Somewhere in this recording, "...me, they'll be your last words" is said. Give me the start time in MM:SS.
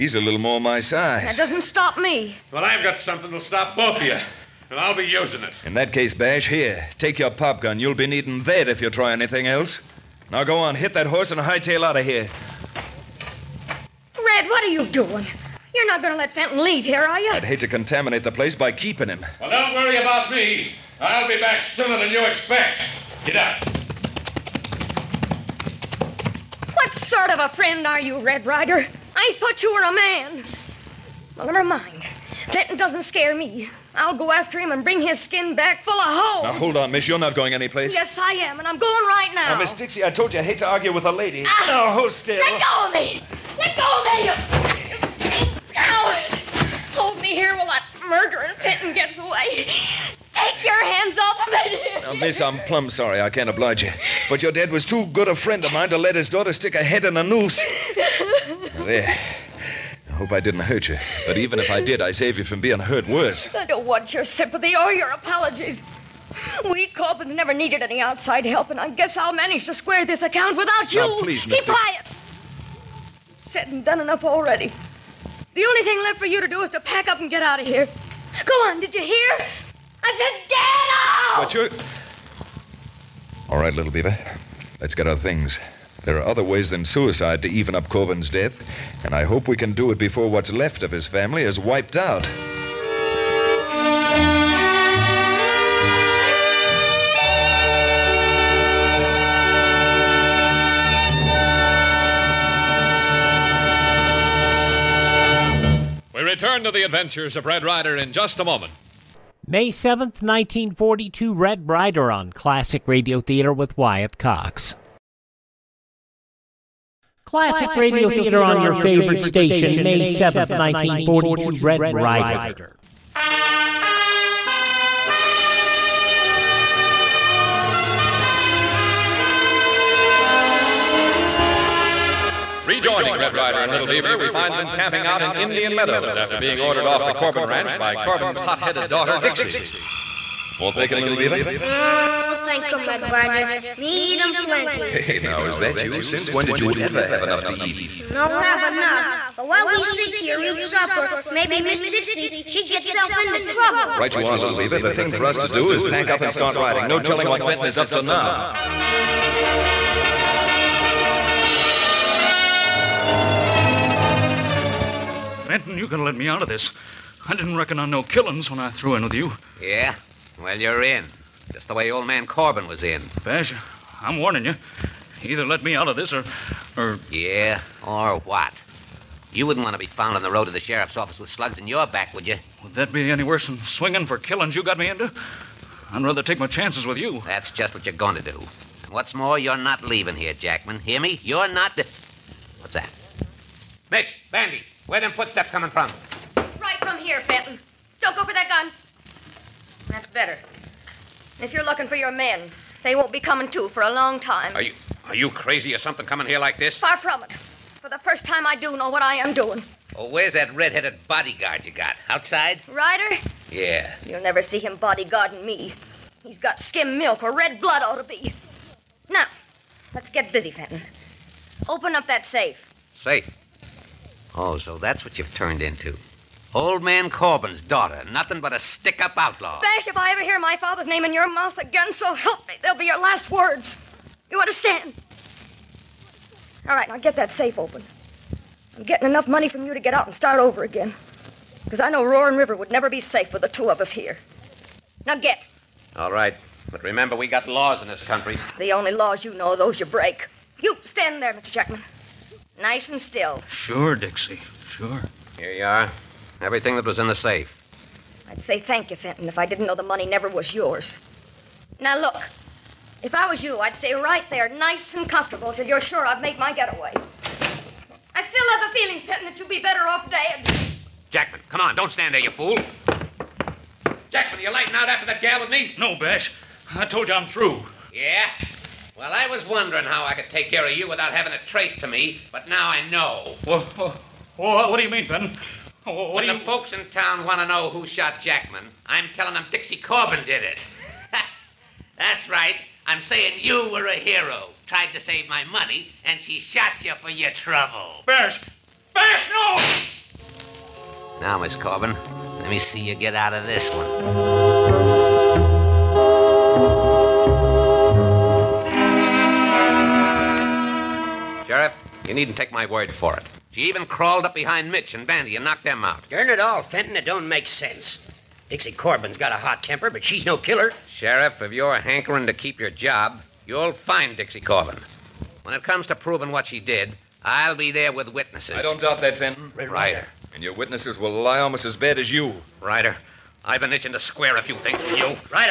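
03:52.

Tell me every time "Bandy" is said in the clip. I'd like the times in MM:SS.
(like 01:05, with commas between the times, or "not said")
03:14, 05:15.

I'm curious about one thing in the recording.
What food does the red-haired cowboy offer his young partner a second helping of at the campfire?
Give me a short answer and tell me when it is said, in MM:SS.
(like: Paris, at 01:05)
Bacon, at 02:20.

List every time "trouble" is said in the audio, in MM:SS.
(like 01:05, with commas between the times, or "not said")
02:33, 04:57.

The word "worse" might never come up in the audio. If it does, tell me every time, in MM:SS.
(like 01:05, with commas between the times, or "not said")
01:03, 03:03.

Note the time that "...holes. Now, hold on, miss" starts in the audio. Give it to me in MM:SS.
00:36.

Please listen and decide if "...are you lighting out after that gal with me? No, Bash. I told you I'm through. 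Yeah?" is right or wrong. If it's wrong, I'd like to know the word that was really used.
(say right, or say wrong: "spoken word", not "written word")
right.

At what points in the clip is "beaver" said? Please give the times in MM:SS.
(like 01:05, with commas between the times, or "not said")
01:23, 02:13, 02:21, 02:34.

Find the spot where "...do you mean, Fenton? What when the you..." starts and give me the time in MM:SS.
04:44.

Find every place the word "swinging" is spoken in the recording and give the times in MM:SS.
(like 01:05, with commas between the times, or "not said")
03:03.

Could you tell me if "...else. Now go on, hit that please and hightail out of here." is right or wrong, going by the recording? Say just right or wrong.
wrong.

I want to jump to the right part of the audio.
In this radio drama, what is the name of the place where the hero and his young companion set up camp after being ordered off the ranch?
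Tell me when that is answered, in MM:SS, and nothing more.
02:15.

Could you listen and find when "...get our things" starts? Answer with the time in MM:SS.
01:24.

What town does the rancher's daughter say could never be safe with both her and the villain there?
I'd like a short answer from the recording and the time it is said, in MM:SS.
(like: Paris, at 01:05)
Roaring River, at 04:02.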